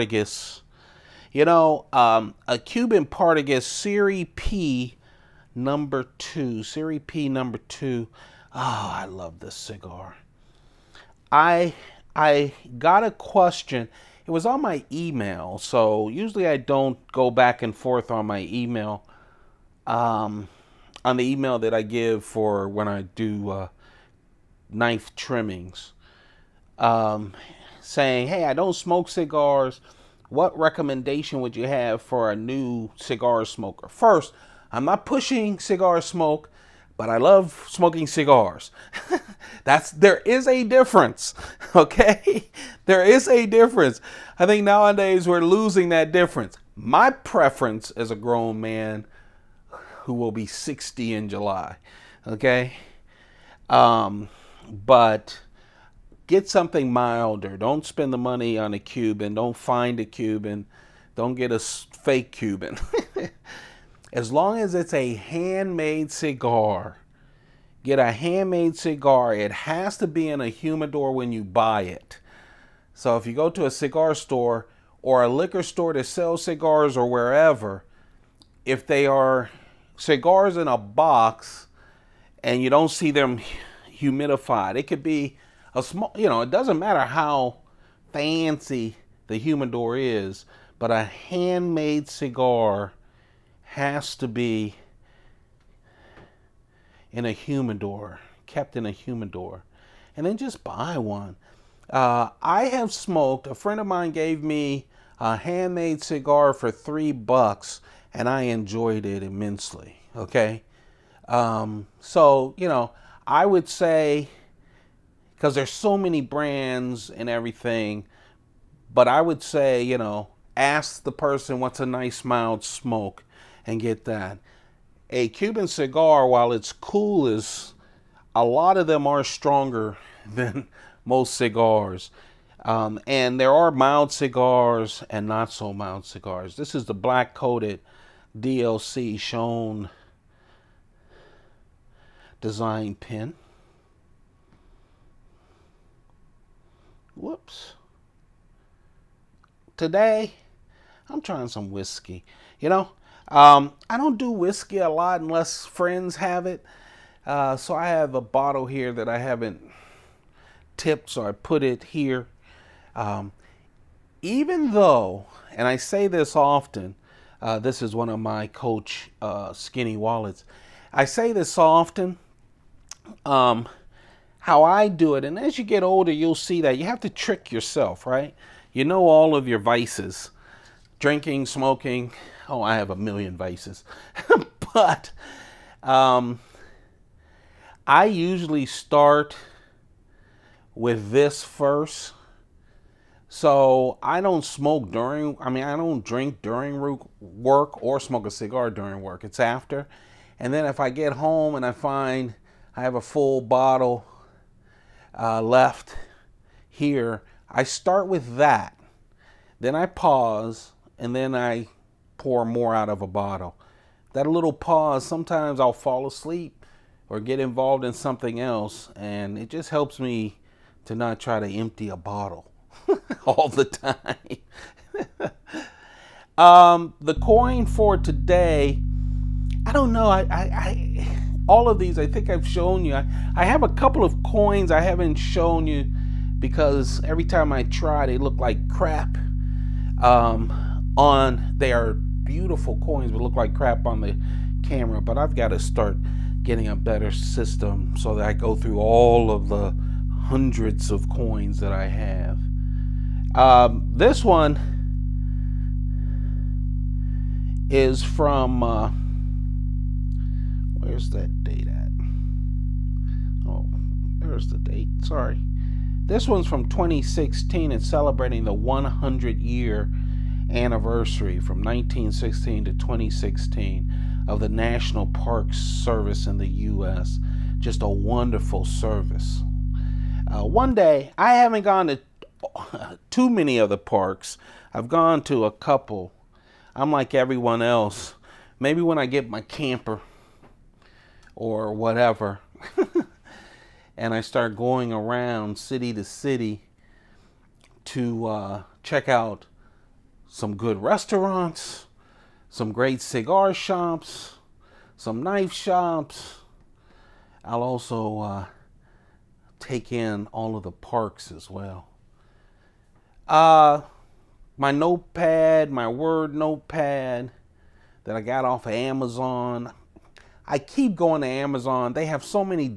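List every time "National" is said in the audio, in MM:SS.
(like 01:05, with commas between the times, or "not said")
04:34.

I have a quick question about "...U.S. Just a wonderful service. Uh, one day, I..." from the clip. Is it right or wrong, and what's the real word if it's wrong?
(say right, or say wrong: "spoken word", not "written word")
right.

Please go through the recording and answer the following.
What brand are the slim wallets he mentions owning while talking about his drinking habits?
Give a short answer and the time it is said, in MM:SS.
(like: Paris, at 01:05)
Coach, at 02:48.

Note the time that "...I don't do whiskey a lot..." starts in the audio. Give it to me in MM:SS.
02:33.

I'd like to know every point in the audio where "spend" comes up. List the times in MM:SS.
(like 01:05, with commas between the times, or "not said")
00:57.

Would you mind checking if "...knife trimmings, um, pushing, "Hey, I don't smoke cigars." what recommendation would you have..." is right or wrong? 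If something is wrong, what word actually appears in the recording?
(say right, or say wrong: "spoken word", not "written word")
wrong: "saying", not "pushing".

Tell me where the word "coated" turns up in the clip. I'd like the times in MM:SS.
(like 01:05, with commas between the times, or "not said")
02:17.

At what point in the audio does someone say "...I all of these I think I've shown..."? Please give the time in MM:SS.
03:50.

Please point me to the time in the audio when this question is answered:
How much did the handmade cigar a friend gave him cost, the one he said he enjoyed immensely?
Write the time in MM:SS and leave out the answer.
01:46.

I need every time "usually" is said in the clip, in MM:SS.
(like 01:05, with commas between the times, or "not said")
00:16, 03:08.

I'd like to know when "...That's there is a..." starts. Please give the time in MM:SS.
00:39.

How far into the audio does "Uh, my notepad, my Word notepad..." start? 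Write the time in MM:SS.
05:13.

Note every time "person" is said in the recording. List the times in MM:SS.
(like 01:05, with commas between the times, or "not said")
02:01.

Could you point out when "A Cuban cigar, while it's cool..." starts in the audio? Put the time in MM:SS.
02:05.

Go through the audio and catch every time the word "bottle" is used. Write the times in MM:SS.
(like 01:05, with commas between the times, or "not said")
02:38, 03:23, 03:33, 03:41.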